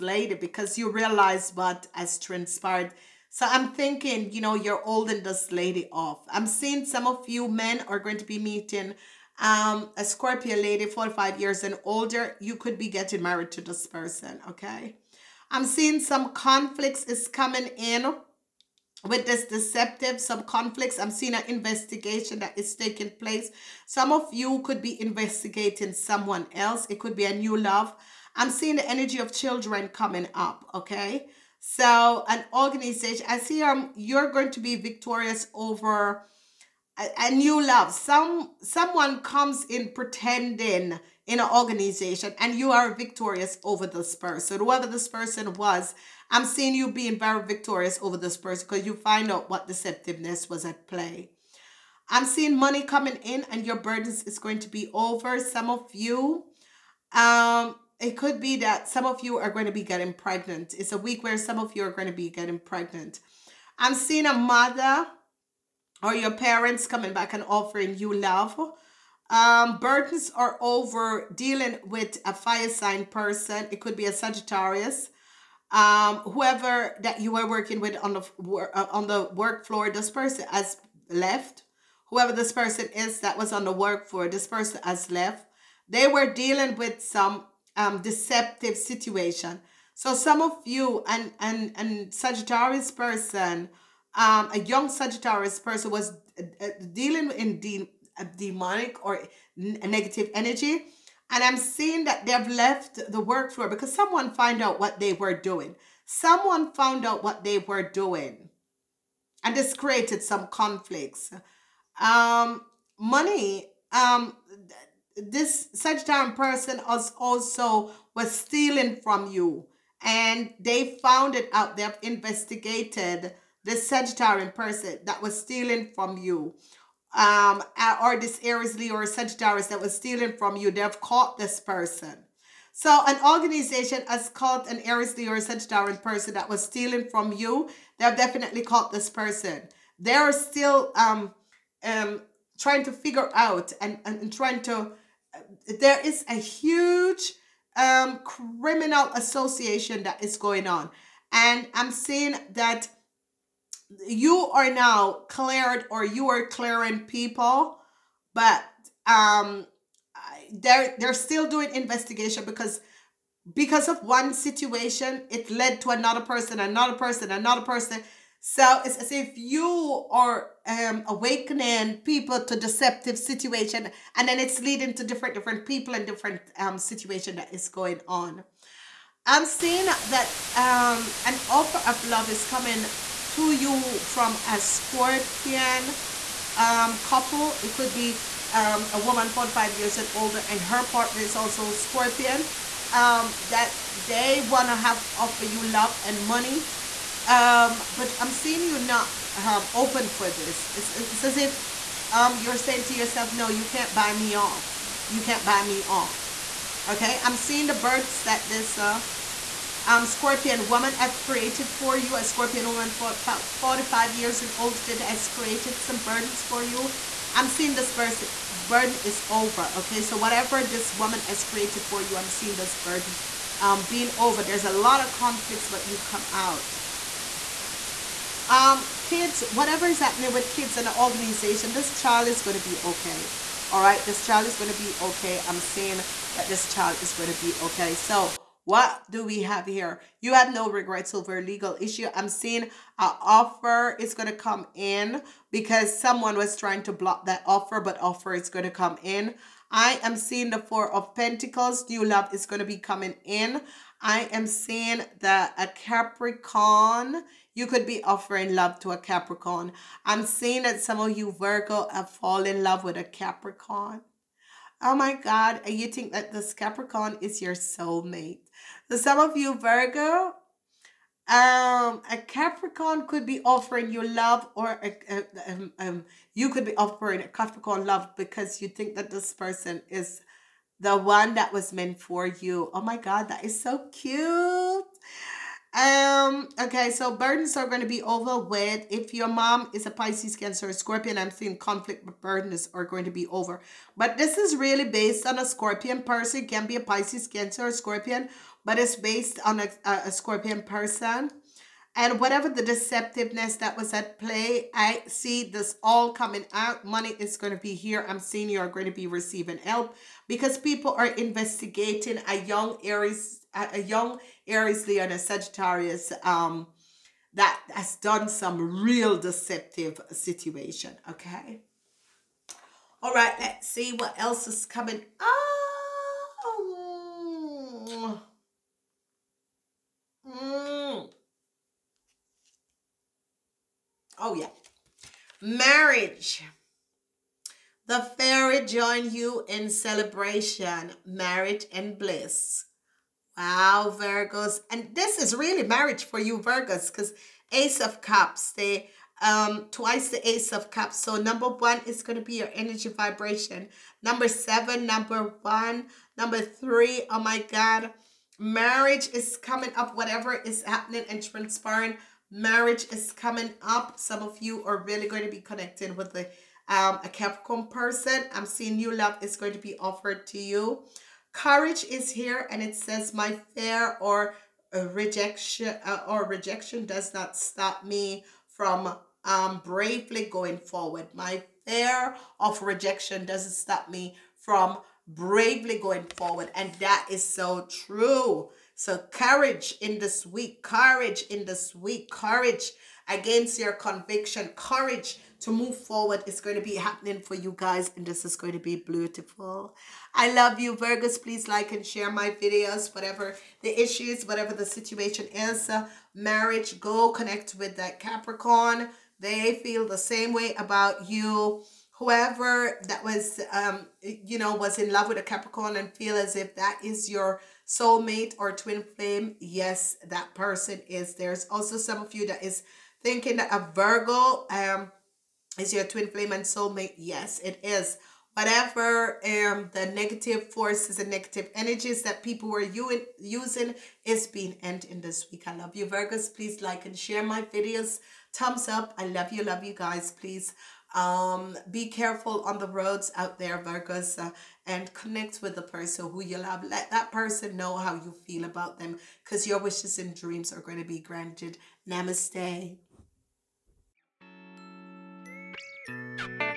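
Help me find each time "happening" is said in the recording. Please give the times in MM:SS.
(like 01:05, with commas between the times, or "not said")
03:49, 06:00, 06:36.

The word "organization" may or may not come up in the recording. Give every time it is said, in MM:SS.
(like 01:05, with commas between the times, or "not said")
00:32, 00:41, 02:13, 03:51.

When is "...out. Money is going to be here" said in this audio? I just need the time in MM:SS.
05:06.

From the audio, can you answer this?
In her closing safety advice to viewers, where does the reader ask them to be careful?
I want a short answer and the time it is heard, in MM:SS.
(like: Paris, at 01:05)
On the roads, at 07:22.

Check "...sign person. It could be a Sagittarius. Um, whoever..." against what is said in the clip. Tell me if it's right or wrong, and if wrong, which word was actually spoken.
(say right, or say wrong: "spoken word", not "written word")
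right.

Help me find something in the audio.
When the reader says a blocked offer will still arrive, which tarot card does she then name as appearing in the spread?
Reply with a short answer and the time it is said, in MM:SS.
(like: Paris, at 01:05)
Four of Pentacles, at 04:10.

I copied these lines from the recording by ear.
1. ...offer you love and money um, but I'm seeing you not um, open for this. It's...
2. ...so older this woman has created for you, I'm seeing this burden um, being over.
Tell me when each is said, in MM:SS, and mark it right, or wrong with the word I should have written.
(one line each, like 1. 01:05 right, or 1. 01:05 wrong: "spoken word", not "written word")
1. 03:15 right
2. 03:40 wrong: "whatever", not "older".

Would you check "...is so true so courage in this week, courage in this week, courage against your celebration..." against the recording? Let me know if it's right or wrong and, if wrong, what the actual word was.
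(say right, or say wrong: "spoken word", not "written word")
wrong: "conviction", not "celebration".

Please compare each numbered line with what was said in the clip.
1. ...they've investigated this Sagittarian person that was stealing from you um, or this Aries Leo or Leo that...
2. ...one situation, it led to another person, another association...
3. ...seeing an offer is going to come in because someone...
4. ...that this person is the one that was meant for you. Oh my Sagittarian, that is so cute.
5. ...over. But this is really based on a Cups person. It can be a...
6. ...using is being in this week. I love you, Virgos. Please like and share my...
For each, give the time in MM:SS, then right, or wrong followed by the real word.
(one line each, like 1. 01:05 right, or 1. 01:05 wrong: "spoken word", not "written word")
1. 02:01 wrong: "Sagittarius", not "Leo"
2. 02:44 wrong: "person", not "association"
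3. 04:02 right
4. 04:38 wrong: "God", not "Sagittarian"
5. 04:53 wrong: "Scorpion", not "Cups"
6. 07:13 right.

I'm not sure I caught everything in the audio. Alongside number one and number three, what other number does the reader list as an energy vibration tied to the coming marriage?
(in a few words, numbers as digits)
7.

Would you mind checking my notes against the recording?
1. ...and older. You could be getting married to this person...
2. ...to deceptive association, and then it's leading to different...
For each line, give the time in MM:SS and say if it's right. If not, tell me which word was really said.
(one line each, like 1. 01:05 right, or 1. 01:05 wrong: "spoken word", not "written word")
1. 00:11 right
2. 02:52 wrong: "situation", not "association".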